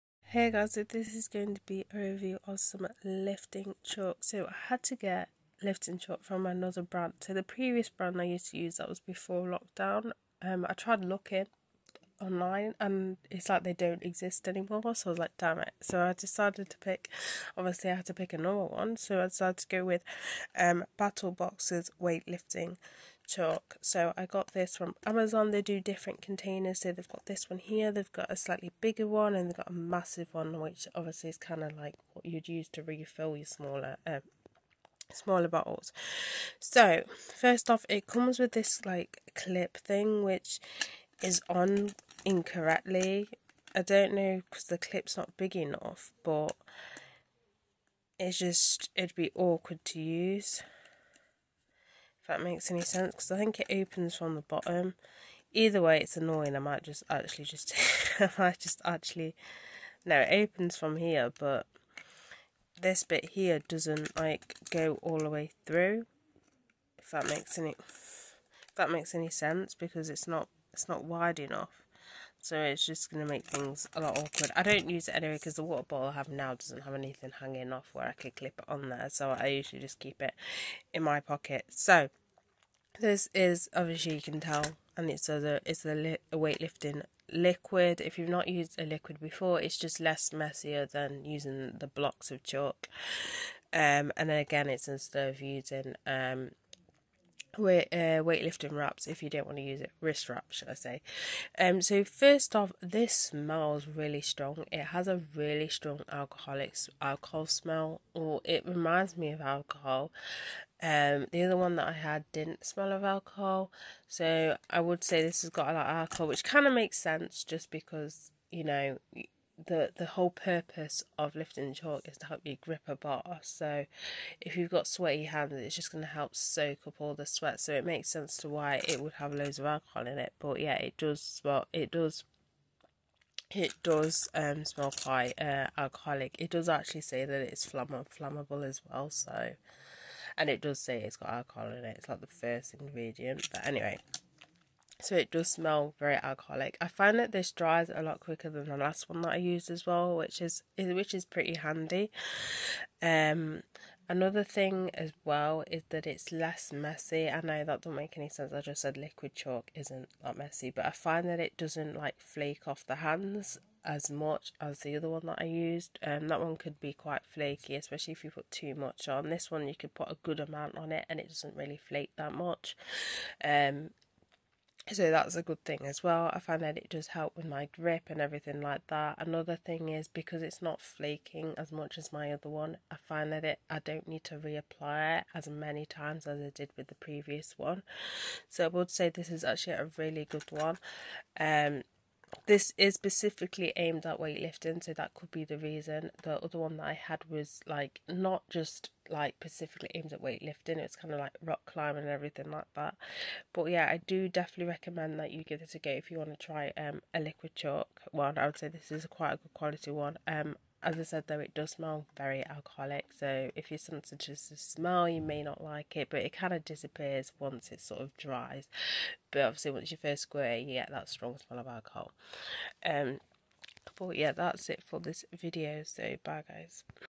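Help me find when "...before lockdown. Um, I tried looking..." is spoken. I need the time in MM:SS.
00:09.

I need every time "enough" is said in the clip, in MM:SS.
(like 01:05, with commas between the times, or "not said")
00:45, 01:11.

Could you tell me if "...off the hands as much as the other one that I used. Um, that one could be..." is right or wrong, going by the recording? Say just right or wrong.
right.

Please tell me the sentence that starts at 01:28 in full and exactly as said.
If you've not used a liquid before, it's just less messier than using the blocks of chalk.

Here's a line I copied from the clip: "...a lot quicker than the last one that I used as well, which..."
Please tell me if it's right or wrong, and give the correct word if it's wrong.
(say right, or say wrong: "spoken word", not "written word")
right.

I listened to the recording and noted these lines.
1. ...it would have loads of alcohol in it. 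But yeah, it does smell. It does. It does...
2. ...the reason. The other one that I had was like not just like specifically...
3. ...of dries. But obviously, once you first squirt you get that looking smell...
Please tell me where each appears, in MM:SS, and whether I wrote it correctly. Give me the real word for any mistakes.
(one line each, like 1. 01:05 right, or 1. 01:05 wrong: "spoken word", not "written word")
1. 02:08 right
2. 03:15 right
3. 03:38 wrong: "strong", not "looking".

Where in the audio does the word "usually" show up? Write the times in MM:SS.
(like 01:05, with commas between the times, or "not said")
01:19.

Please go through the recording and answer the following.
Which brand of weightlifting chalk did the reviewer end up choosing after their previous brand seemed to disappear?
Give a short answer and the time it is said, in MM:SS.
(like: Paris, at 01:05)
Battlebox, at 00:20.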